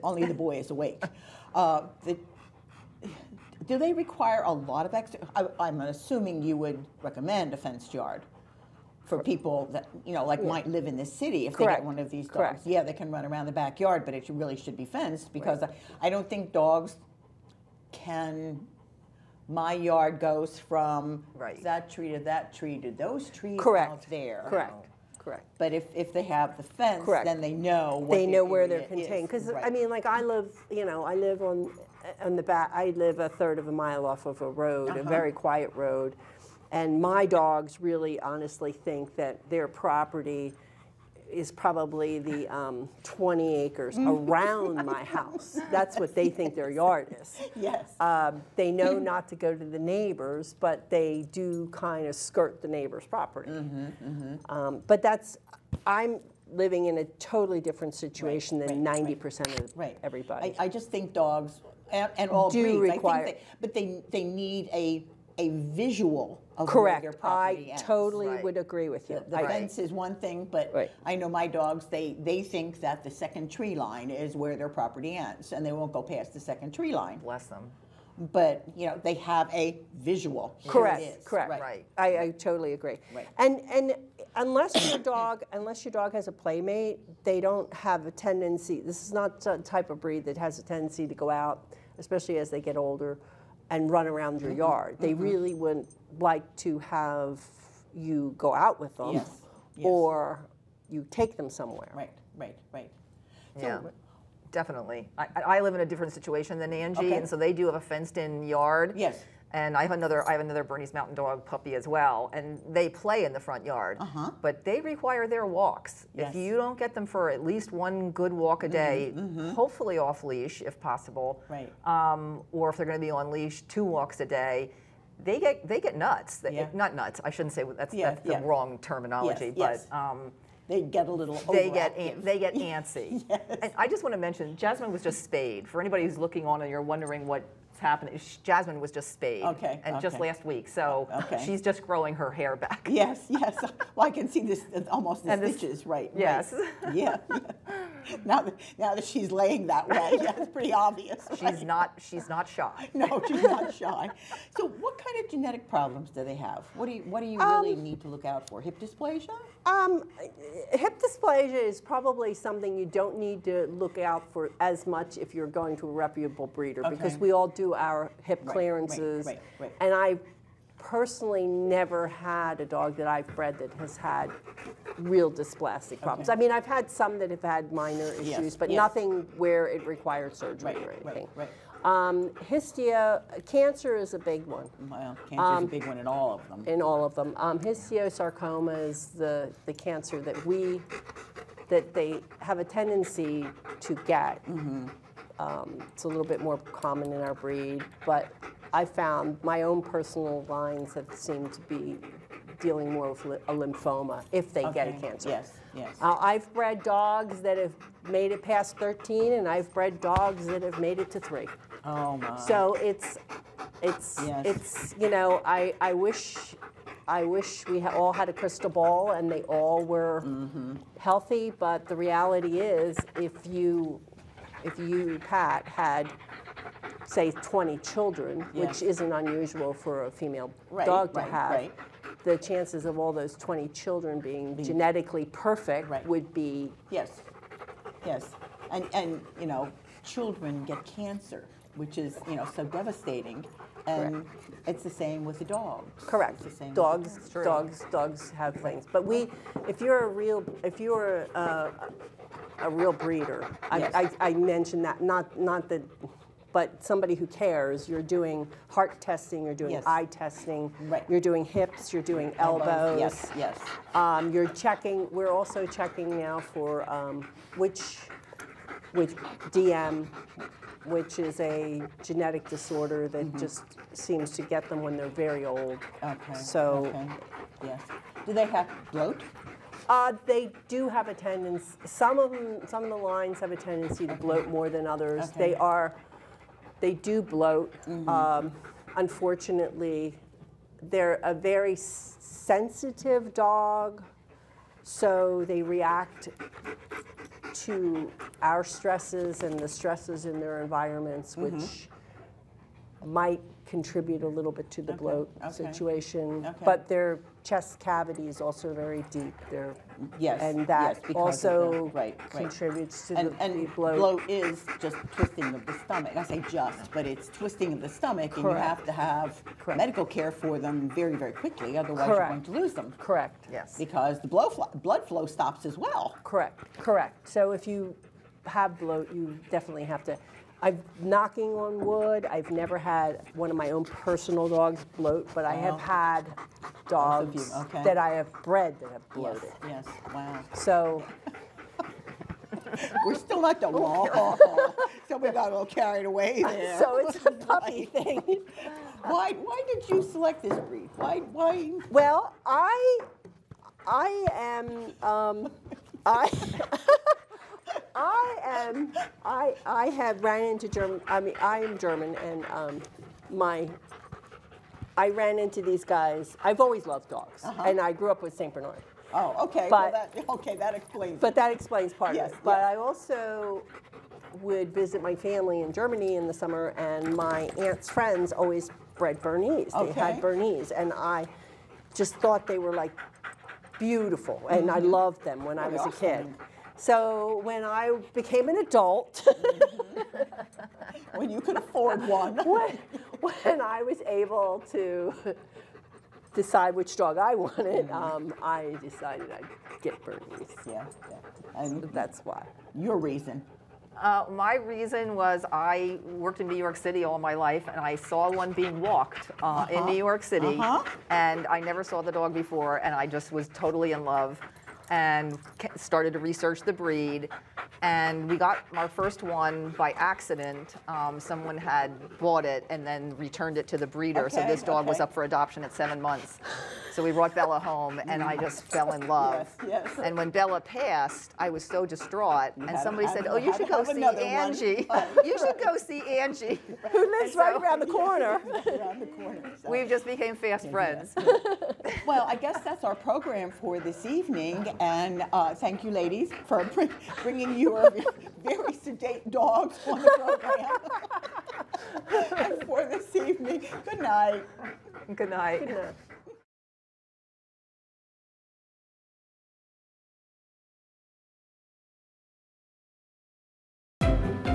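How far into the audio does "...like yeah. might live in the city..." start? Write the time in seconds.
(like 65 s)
10 s.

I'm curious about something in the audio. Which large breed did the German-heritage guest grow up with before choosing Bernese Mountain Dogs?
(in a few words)
Saint Bernard.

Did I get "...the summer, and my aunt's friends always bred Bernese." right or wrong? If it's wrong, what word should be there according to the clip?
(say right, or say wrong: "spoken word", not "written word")
right.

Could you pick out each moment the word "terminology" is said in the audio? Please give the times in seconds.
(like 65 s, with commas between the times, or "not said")
128 s.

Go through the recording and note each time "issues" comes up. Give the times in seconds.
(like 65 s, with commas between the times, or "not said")
178 s.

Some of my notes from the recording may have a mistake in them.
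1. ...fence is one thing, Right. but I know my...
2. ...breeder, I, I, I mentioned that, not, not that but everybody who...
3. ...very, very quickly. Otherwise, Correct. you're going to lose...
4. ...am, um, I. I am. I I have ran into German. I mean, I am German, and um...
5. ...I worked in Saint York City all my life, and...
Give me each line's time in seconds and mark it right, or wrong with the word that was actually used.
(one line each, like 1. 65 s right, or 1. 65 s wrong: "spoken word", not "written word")
1. 69 s right
2. 252 s wrong: "somebody", not "everybody"
3. 320 s right
4. 354 s right
5. 405 s wrong: "New", not "Saint".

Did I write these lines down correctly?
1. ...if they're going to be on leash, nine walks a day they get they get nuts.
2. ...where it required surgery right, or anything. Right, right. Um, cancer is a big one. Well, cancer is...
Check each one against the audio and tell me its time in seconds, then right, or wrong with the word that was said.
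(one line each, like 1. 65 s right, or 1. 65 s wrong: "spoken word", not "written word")
1. 122 s wrong: "two", not "nine"
2. 179 s right.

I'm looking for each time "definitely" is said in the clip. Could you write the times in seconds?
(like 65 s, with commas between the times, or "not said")
104 s, 329 s.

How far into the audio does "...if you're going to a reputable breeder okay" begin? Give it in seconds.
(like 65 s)
165 s.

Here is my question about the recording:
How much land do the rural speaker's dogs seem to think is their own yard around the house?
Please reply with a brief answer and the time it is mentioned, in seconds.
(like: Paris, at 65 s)
20 acres, at 43 s.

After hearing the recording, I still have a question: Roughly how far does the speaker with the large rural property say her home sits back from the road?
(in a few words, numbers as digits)
a third of a mile.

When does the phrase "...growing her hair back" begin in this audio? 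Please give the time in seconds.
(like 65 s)
141 s.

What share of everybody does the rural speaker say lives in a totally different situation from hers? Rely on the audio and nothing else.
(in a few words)
90%.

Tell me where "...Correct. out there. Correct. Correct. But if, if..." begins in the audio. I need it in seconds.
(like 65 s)
23 s.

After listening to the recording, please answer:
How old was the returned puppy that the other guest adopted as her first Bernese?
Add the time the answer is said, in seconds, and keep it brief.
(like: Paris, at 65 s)
7 months, at 425 s.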